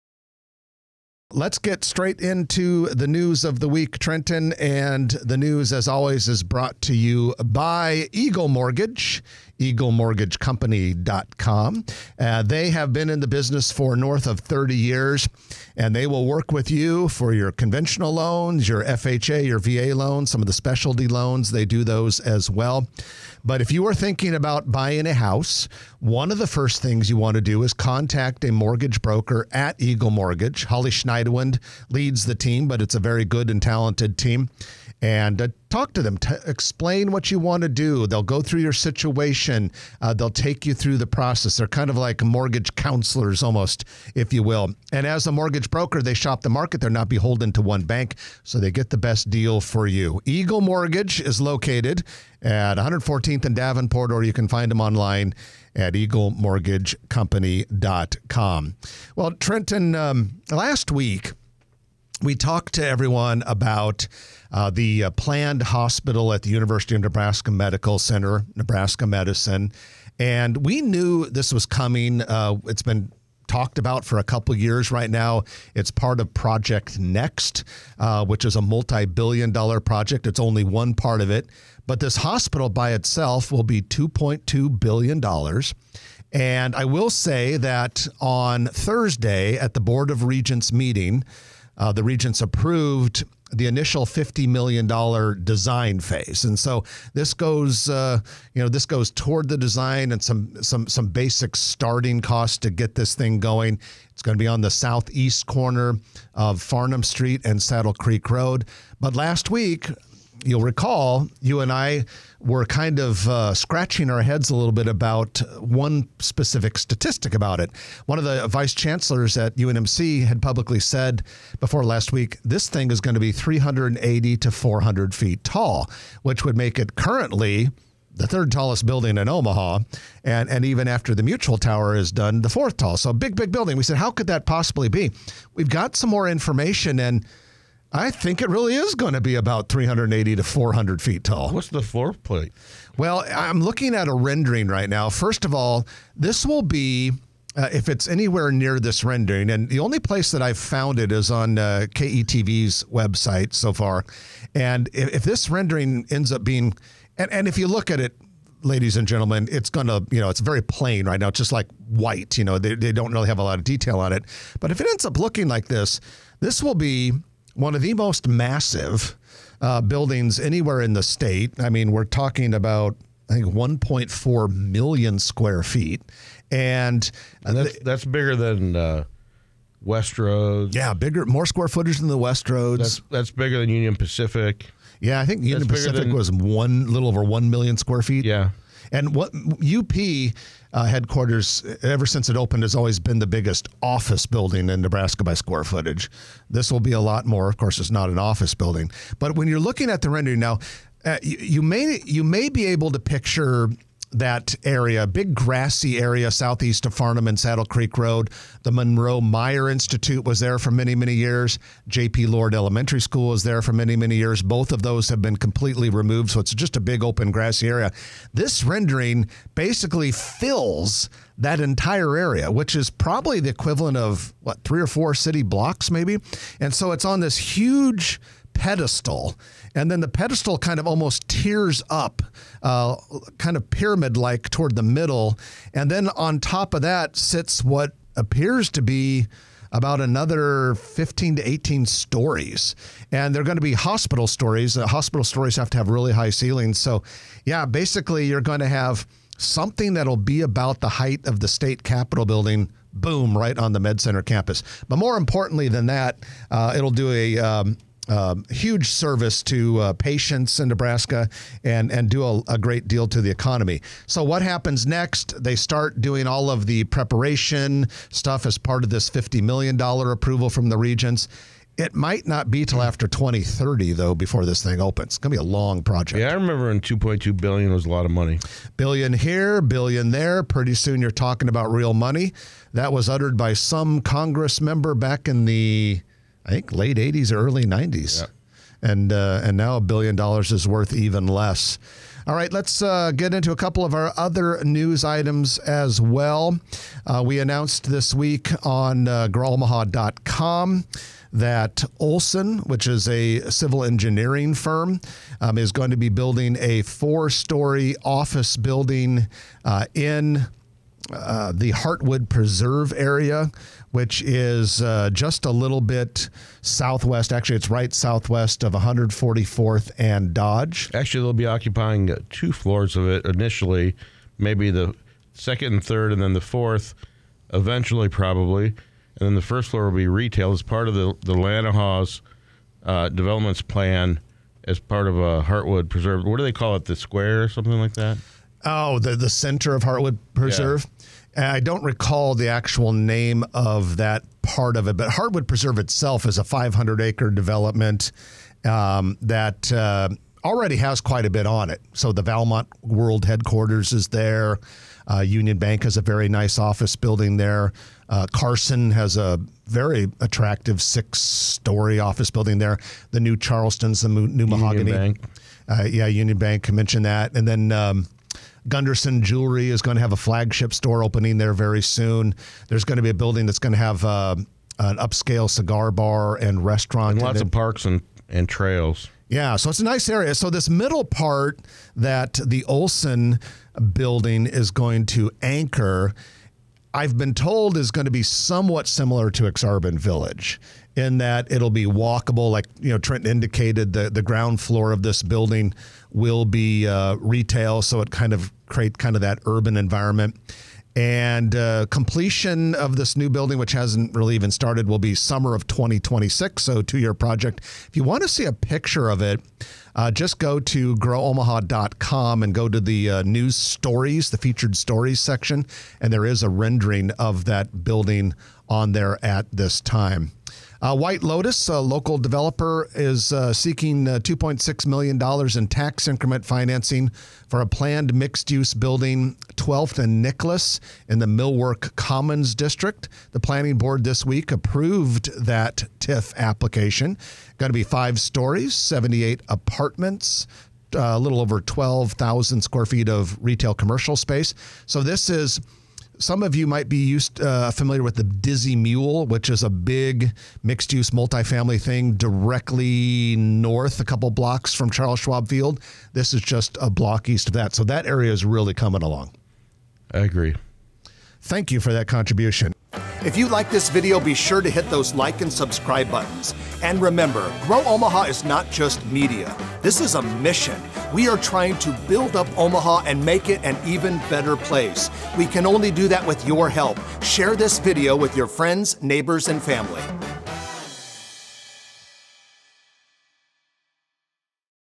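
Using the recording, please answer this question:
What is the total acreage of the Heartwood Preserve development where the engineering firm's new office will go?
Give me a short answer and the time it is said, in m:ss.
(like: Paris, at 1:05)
500 acres, at 5:46.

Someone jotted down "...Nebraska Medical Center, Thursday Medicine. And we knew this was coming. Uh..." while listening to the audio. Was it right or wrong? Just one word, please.
wrong.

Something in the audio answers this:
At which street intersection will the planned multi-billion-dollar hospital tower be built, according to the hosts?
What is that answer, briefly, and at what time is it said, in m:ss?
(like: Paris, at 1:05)
Farnam Street and Saddle Creek Road, at 1:46.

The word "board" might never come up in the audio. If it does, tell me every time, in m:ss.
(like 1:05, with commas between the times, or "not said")
1:29, 7:13.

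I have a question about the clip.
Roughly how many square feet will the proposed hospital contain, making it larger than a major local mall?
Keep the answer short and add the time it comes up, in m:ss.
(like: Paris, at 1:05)
1.4 million, at 2:53.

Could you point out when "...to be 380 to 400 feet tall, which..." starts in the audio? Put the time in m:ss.
2:03.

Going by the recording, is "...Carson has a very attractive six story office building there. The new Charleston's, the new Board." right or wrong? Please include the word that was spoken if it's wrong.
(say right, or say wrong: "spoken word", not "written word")
wrong: "Mahogany", not "Board".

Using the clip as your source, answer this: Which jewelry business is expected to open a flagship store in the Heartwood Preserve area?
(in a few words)
Gunderson Jewelry.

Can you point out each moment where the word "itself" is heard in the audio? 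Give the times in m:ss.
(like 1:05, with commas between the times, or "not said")
1:22, 5:45.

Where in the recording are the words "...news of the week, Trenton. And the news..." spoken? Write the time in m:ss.
0:03.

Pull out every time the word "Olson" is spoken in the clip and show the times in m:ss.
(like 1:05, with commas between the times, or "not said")
5:01, 6:22.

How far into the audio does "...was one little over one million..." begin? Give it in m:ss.
3:06.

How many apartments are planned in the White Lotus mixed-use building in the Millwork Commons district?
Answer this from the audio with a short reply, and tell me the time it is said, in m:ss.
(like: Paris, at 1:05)
78, at 7:18.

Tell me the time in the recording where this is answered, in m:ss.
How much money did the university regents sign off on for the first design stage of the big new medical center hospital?
1:34.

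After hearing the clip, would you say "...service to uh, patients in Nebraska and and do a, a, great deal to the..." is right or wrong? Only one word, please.
right.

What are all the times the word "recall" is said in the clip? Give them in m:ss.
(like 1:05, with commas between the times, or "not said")
1:50, 5:41.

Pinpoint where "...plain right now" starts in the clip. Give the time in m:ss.
2:40.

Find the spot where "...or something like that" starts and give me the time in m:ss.
5:37.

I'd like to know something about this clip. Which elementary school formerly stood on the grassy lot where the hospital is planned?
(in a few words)
J.P. Lord Elementary School.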